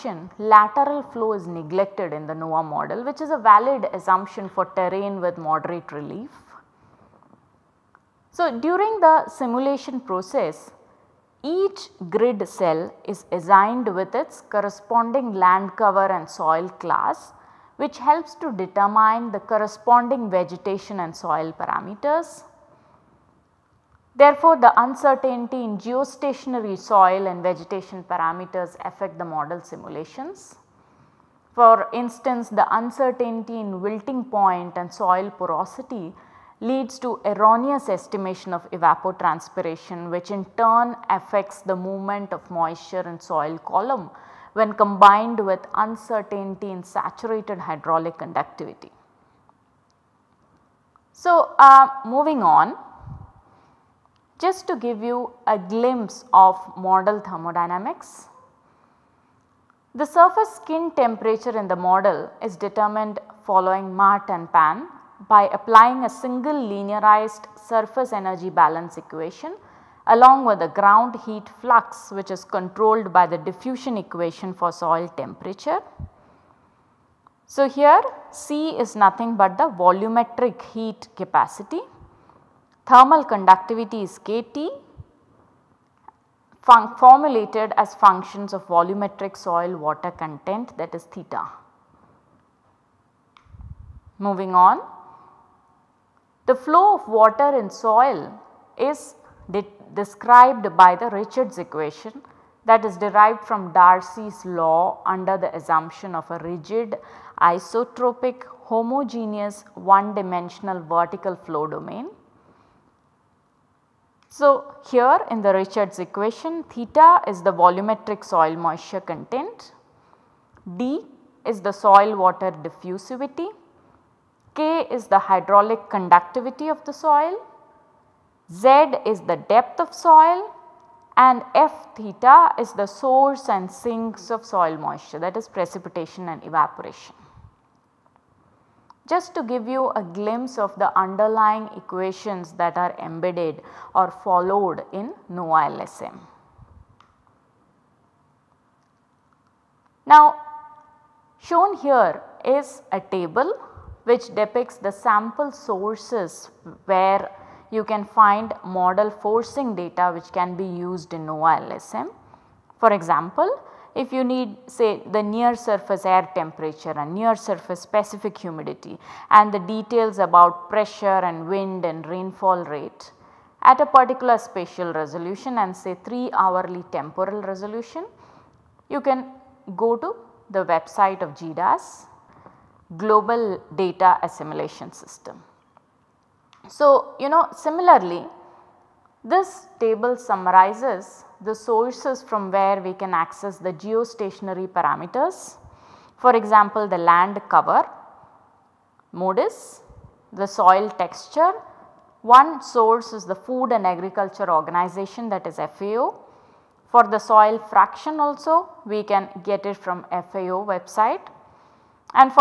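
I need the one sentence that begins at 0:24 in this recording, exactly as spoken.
Therefore, the uncertainty in geostationary soil and vegetation parameters affect the model simulations.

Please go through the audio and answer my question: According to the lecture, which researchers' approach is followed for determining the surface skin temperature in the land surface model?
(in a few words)
Mahrt and Pan.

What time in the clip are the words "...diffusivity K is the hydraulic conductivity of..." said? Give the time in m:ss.
2:02.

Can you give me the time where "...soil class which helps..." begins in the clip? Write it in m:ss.
0:16.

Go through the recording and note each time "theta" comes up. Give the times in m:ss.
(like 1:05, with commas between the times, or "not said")
1:31, 1:56, 2:11.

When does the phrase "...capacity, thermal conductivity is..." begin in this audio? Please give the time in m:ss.
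1:21.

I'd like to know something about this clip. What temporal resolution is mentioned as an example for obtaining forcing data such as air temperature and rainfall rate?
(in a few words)
3 hourly.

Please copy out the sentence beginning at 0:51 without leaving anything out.
So, uh, moving on just to give you a glimpse of model thermodynamics.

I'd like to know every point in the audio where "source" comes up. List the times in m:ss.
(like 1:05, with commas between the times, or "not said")
2:12, 2:35, 3:11, 3:22.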